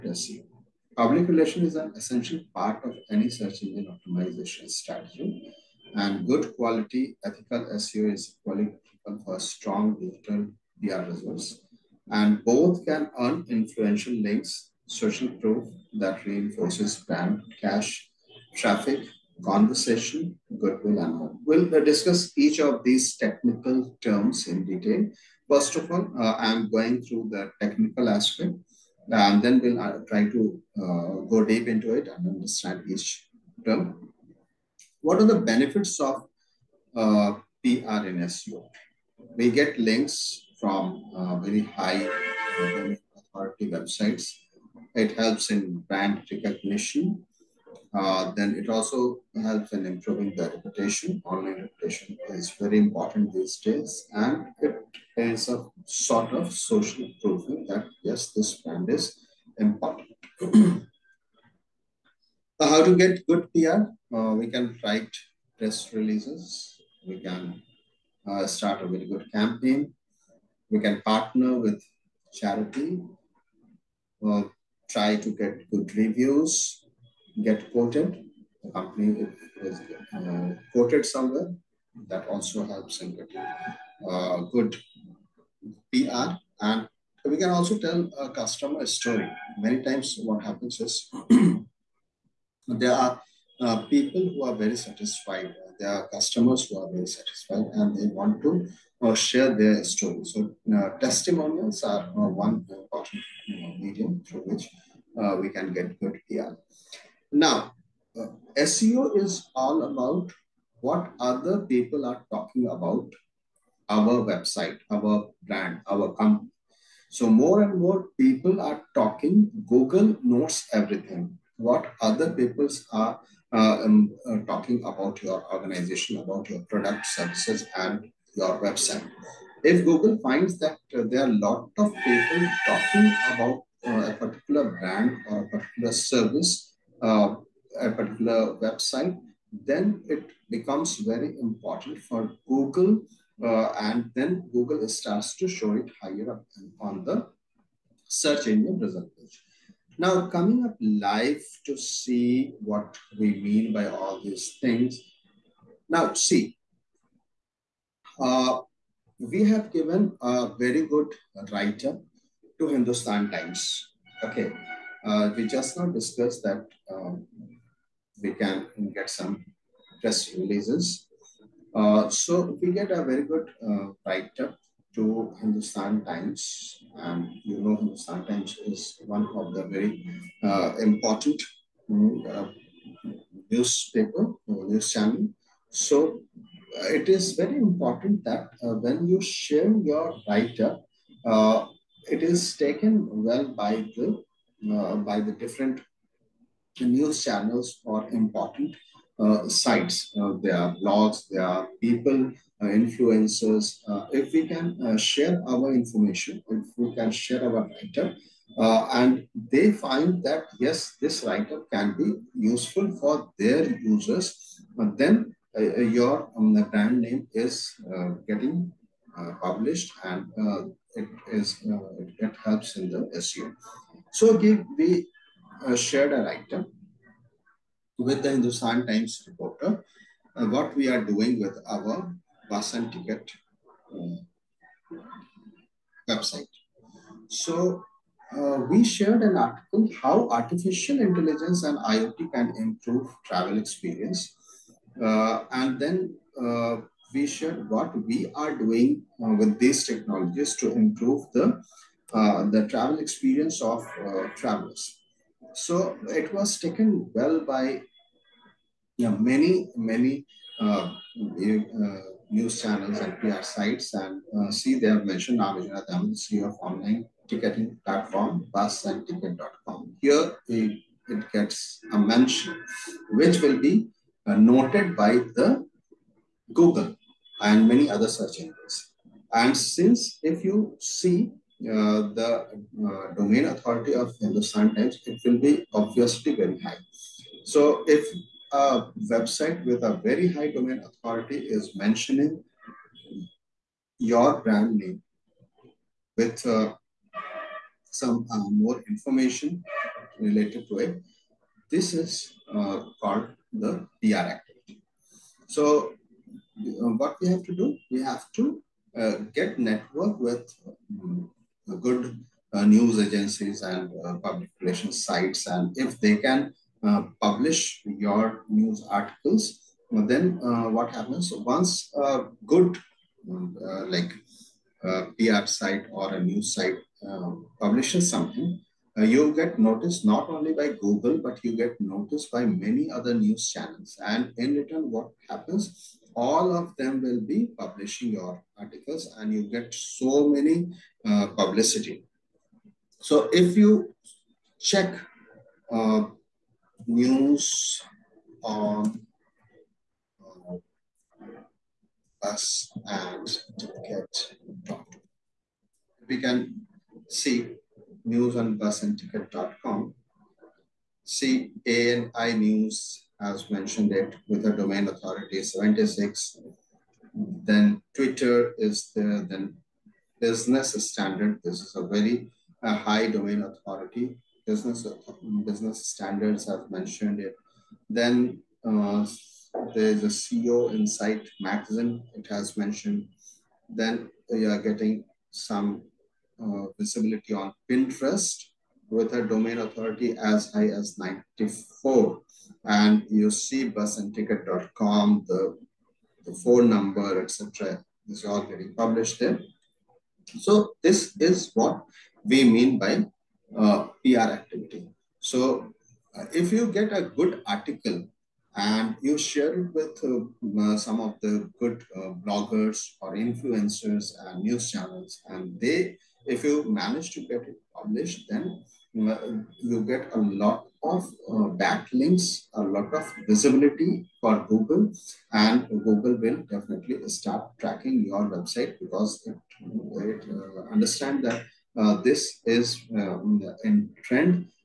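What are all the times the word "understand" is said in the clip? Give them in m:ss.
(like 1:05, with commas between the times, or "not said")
0:32, 7:10.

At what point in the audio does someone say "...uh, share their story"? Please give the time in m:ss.
1:39.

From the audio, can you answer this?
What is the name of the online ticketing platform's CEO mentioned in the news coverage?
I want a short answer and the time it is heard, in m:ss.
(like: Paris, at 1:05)
Avijana, at 4:25.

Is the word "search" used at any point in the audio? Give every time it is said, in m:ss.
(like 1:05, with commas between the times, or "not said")
0:03, 2:28, 4:38.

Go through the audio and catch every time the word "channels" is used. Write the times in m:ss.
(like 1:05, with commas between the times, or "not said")
3:04, 3:17, 4:22, 5:33, 6:54.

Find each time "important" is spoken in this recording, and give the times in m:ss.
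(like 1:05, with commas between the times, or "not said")
0:52, 0:59, 1:42, 2:21, 3:00, 3:07, 3:18.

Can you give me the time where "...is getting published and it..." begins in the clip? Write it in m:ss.
3:37.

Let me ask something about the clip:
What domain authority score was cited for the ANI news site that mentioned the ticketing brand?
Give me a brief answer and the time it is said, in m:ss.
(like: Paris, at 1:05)
76, at 6:05.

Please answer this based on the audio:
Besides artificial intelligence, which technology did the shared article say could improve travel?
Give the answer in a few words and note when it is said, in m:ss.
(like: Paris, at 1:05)
IoT, at 4:01.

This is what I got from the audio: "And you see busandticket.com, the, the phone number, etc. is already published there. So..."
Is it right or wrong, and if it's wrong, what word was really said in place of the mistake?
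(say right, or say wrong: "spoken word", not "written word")
right.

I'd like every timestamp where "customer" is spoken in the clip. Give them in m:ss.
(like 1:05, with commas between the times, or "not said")
1:28, 1:36.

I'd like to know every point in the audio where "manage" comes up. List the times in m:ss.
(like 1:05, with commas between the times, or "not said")
6:56.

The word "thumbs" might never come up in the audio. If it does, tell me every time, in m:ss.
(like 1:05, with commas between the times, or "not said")
not said.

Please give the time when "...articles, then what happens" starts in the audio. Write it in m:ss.
5:18.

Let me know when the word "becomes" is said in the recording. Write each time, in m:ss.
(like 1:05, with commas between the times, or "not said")
2:20.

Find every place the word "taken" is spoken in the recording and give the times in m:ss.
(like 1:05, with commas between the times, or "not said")
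3:12, 4:16.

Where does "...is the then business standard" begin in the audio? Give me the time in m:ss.
6:08.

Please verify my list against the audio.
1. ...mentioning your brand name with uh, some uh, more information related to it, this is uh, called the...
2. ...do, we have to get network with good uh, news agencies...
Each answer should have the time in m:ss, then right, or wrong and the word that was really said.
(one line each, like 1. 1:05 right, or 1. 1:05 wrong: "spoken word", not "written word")
1. 4:51 right
2. 5:07 right.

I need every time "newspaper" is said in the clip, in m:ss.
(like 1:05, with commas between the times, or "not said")
3:03.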